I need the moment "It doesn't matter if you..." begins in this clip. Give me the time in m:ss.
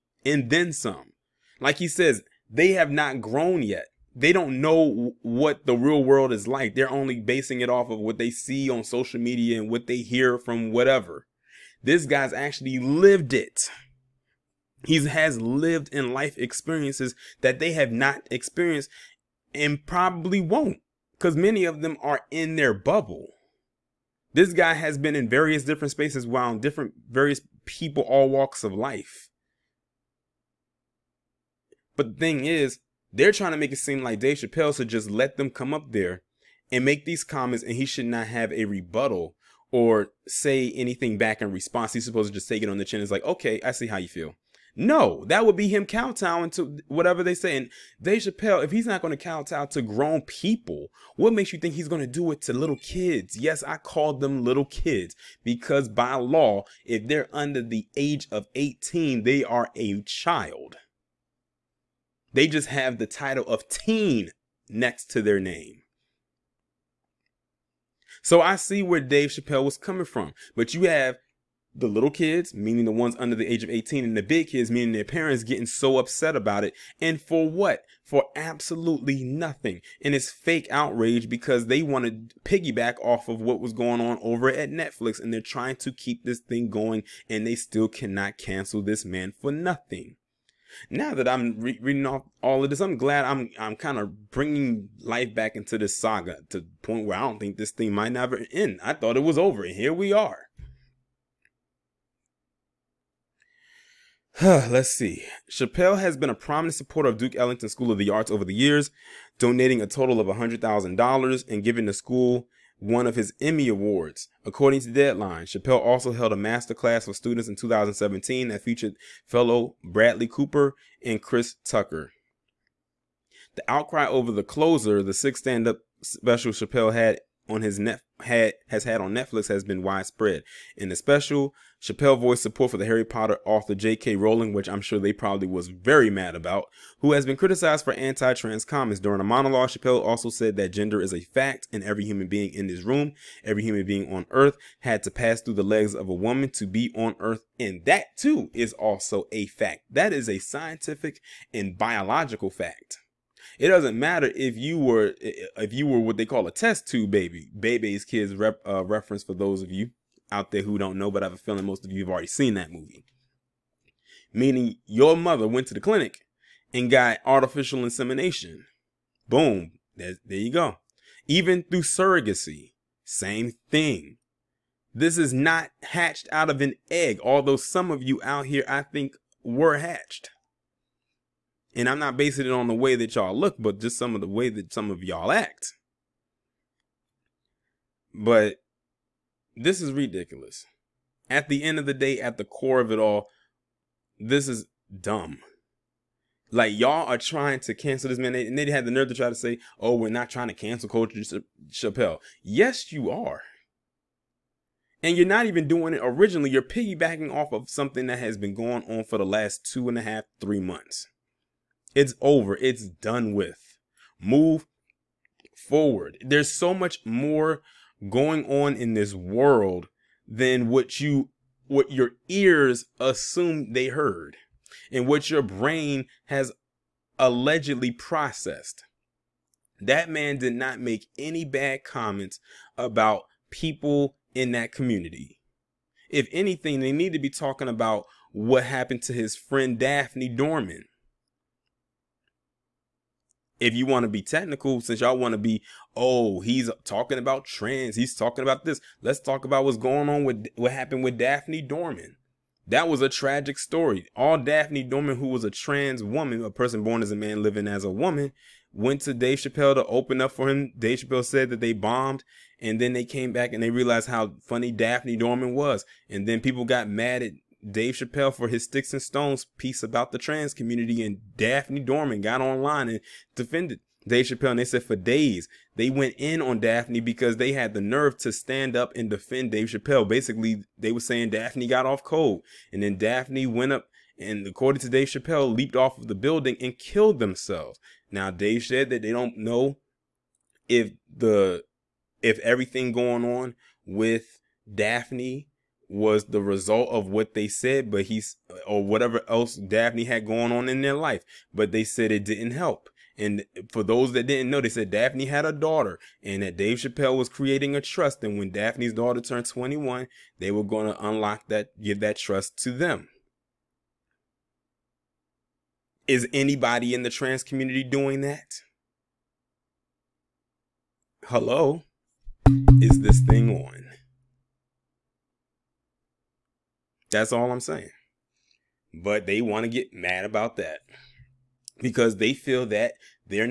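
2:33.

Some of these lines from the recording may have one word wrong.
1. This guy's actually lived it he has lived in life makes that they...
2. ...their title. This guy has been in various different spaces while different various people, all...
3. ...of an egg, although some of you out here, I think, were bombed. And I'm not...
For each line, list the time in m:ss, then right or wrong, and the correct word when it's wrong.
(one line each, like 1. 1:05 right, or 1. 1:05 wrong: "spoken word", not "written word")
1. 0:11 wrong: "experiences", not "makes"
2. 0:22 wrong: "bubble", not "title"
3. 2:56 wrong: "hatched", not "bombed".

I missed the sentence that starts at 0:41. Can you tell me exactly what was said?
He's supposed to just take it on the chin.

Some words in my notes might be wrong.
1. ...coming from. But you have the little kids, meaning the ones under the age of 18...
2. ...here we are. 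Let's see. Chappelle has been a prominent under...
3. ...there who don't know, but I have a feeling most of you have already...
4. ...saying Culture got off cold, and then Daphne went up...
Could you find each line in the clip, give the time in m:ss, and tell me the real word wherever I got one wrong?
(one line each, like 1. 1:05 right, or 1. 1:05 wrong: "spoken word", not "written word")
1. 1:09 right
2. 1:39 wrong: "supporter", not "under"
3. 2:40 right
4. 4:40 wrong: "Daphne", not "Culture".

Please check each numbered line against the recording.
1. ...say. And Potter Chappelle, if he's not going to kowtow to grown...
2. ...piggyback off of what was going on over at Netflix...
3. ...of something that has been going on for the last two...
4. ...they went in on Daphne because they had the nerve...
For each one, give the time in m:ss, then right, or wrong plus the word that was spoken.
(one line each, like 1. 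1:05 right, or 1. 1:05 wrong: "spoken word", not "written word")
1. 0:47 wrong: "Dave", not "Potter"
2. 1:22 right
3. 3:27 right
4. 4:35 right.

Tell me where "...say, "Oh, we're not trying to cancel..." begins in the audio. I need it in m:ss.
3:19.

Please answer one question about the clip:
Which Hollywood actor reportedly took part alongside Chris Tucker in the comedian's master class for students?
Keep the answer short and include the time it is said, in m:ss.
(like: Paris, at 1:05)
Bradley Cooper, at 1:59.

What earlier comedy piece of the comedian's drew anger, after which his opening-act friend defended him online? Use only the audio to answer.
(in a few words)
Sticks and Stones.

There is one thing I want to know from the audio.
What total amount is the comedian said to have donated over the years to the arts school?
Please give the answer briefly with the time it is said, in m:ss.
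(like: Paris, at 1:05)
$100,000, at 1:50.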